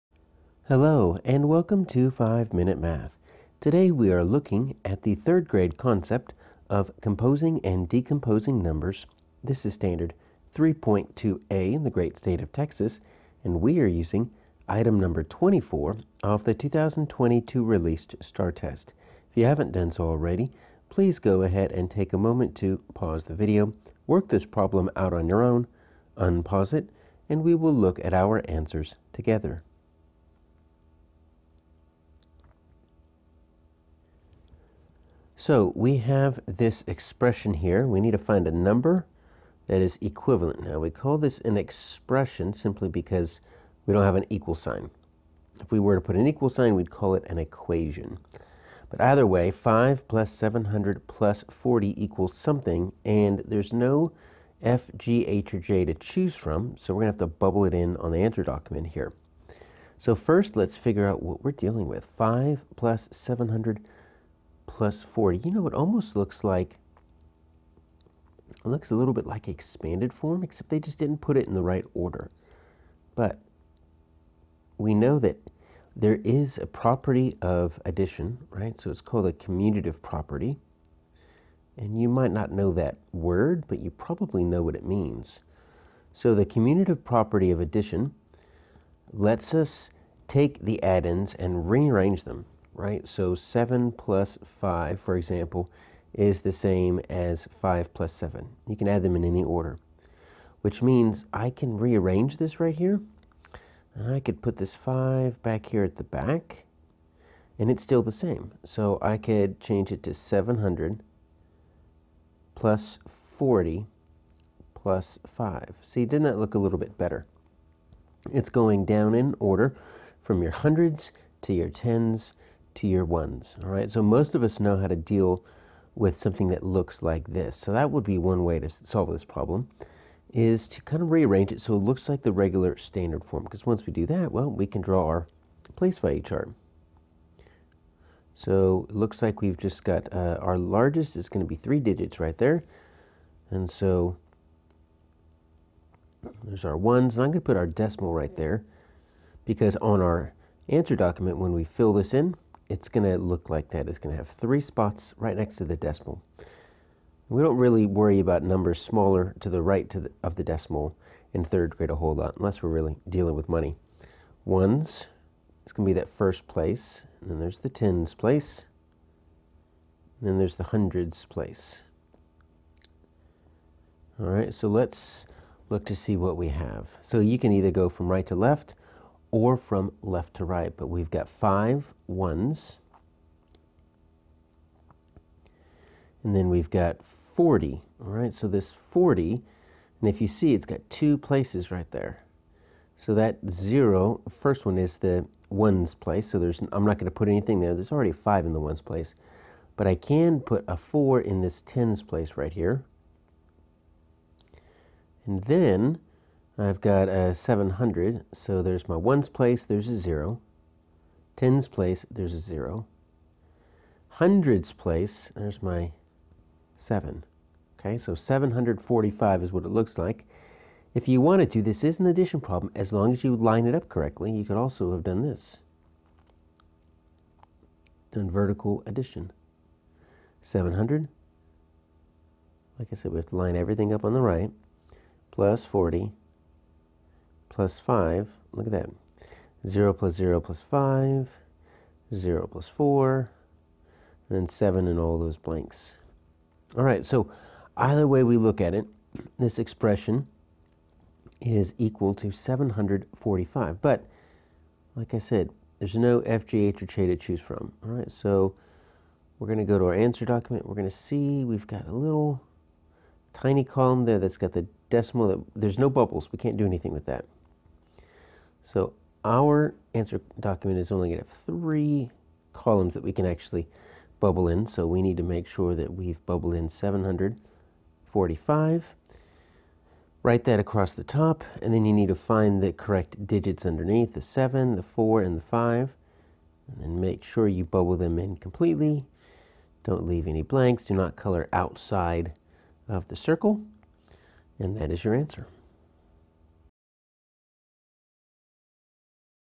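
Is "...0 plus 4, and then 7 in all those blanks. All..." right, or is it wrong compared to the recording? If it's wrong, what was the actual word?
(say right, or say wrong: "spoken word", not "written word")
right.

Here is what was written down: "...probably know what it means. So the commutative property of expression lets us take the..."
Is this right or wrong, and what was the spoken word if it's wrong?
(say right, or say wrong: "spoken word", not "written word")
wrong: "addition", not "expression".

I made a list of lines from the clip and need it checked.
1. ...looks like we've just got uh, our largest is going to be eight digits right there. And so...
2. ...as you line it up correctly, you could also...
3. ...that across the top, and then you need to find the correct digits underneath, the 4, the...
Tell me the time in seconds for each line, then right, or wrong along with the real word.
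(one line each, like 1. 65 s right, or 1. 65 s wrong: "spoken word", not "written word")
1. 138 s wrong: "three", not "eight"
2. 223 s right
3. 280 s wrong: "7", not "4".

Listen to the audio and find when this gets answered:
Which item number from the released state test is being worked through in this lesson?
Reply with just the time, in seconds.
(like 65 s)
15 s.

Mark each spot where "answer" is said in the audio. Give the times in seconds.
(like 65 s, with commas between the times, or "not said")
28 s, 58 s, 150 s, 259 s, 269 s, 295 s.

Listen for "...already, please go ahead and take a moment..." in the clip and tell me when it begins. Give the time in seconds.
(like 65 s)
20 s.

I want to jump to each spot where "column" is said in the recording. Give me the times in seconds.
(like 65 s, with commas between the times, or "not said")
263 s, 272 s.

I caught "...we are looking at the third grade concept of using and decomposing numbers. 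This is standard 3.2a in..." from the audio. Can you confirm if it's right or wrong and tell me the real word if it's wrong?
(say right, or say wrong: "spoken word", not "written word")
wrong: "composing", not "using".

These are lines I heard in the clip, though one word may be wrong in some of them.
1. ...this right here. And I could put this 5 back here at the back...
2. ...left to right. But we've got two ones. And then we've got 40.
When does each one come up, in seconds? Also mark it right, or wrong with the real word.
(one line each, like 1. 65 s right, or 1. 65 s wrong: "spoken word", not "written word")
1. 102 s right
2. 180 s wrong: "five", not "two".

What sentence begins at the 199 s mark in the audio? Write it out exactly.
But I can put a four in this tens place right here.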